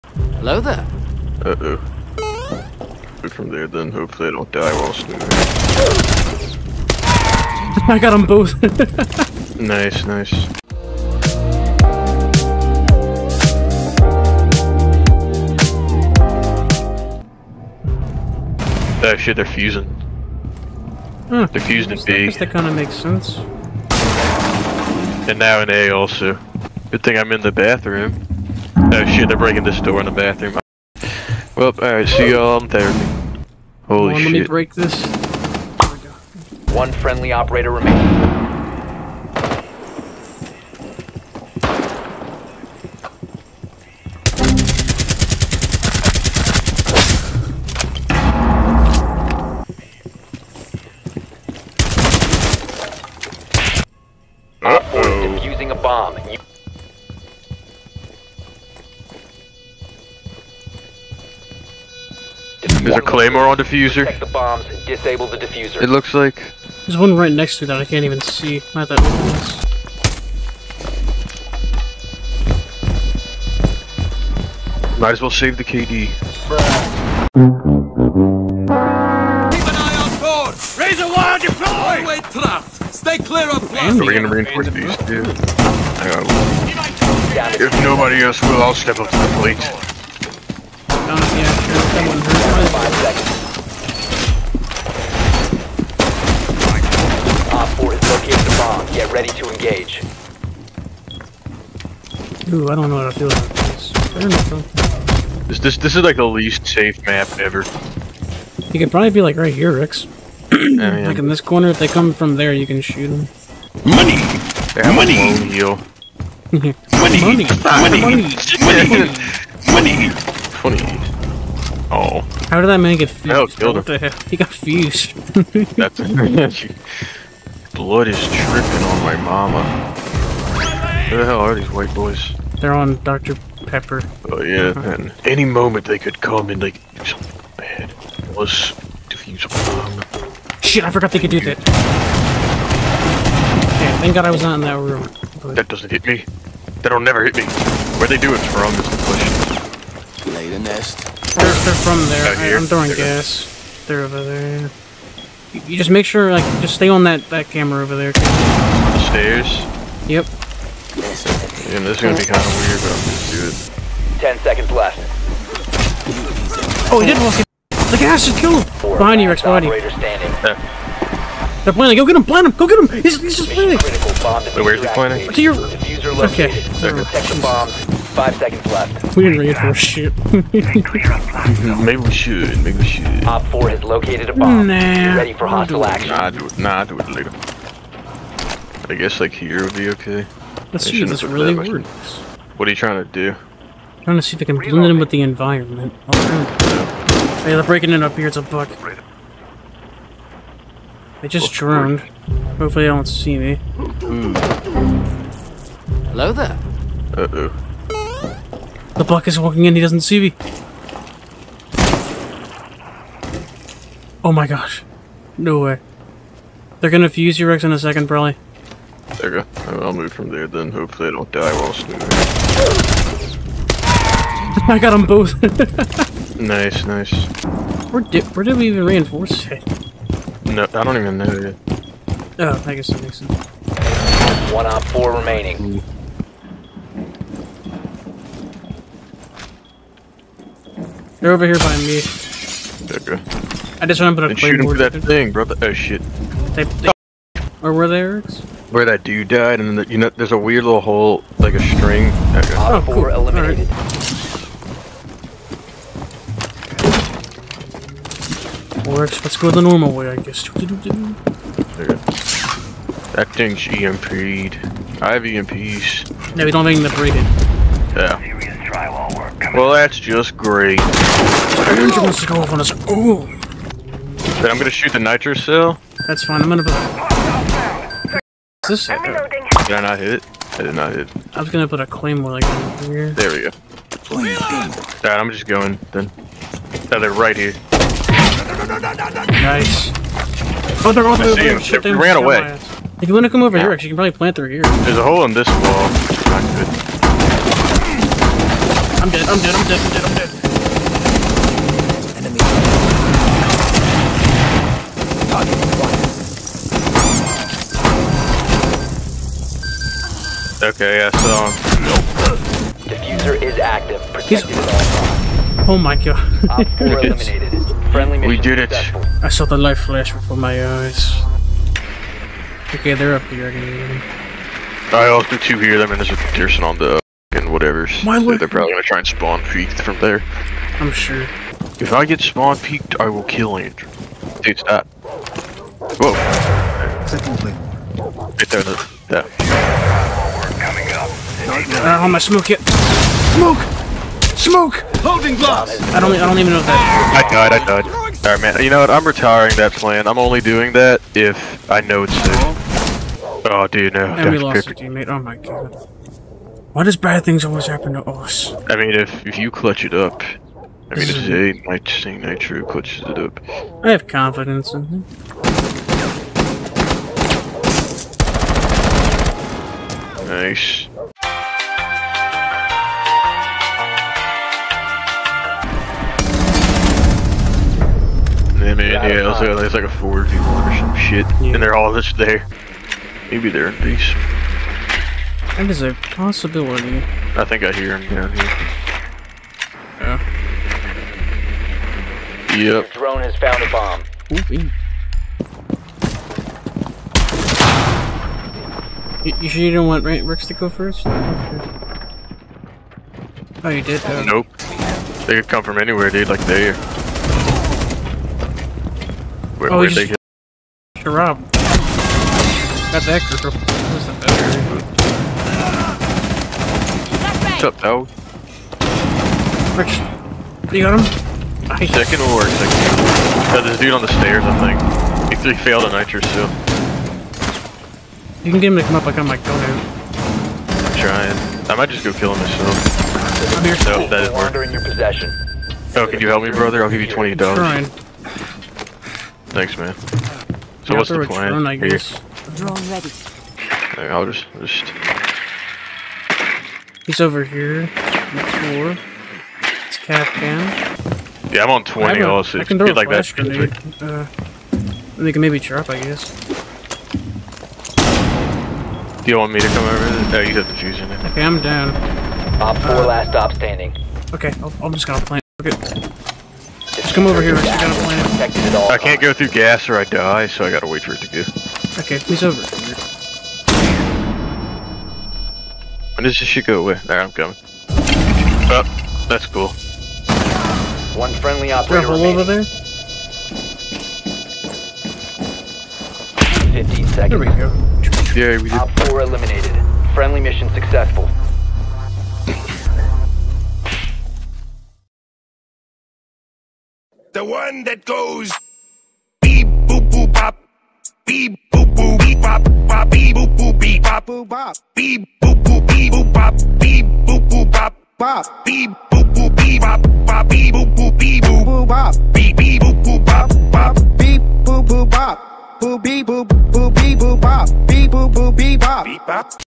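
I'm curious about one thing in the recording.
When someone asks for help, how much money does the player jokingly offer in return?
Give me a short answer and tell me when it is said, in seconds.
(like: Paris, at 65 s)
20 dollars, at 437 s.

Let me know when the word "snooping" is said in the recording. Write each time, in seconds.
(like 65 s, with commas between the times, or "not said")
4 s, 221 s.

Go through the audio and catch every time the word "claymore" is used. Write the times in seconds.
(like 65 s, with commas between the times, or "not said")
63 s, 281 s.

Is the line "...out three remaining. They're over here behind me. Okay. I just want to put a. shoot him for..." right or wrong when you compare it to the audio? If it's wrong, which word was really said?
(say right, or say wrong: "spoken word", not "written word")
wrong: "four", not "three".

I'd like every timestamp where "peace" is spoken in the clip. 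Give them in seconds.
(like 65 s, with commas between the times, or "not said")
383 s.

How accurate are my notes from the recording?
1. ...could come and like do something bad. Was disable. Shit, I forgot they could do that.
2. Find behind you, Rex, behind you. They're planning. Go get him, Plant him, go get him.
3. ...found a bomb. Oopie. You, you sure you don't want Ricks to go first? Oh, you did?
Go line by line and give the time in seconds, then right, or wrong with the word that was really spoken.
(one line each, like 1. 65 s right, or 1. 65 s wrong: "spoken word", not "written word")
1. 135 s wrong: "defusable", not "disable"
2. 168 s right
3. 393 s right.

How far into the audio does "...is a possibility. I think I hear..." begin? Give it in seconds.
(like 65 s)
385 s.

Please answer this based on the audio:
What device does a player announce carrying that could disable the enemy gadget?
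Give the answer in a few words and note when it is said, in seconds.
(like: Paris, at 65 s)
EMPs, at 265 s.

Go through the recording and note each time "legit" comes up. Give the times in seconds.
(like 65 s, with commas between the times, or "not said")
not said.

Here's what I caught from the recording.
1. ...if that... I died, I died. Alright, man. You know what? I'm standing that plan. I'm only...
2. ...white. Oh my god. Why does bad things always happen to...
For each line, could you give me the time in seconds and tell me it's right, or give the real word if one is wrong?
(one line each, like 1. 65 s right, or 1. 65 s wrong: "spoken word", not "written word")
1. 346 s wrong: "retiring", not "standing"
2. 354 s wrong: "teammate", not "white".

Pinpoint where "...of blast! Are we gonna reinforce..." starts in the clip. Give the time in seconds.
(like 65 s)
83 s.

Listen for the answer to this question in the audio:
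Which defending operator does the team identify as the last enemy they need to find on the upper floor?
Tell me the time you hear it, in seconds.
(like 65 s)
449 s.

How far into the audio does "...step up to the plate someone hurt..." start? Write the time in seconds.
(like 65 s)
88 s.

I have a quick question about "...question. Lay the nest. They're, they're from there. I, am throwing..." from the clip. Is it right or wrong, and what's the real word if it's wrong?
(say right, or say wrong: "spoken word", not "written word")
right.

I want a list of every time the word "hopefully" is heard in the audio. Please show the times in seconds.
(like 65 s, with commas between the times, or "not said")
3 s, 202 s, 220 s.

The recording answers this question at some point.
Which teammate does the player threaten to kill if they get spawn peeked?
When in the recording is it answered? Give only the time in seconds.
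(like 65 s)
333 s.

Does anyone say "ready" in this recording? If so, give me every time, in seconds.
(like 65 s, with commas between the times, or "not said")
99 s, 185 s, 442 s.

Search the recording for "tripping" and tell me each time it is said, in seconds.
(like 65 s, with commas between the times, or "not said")
128 s.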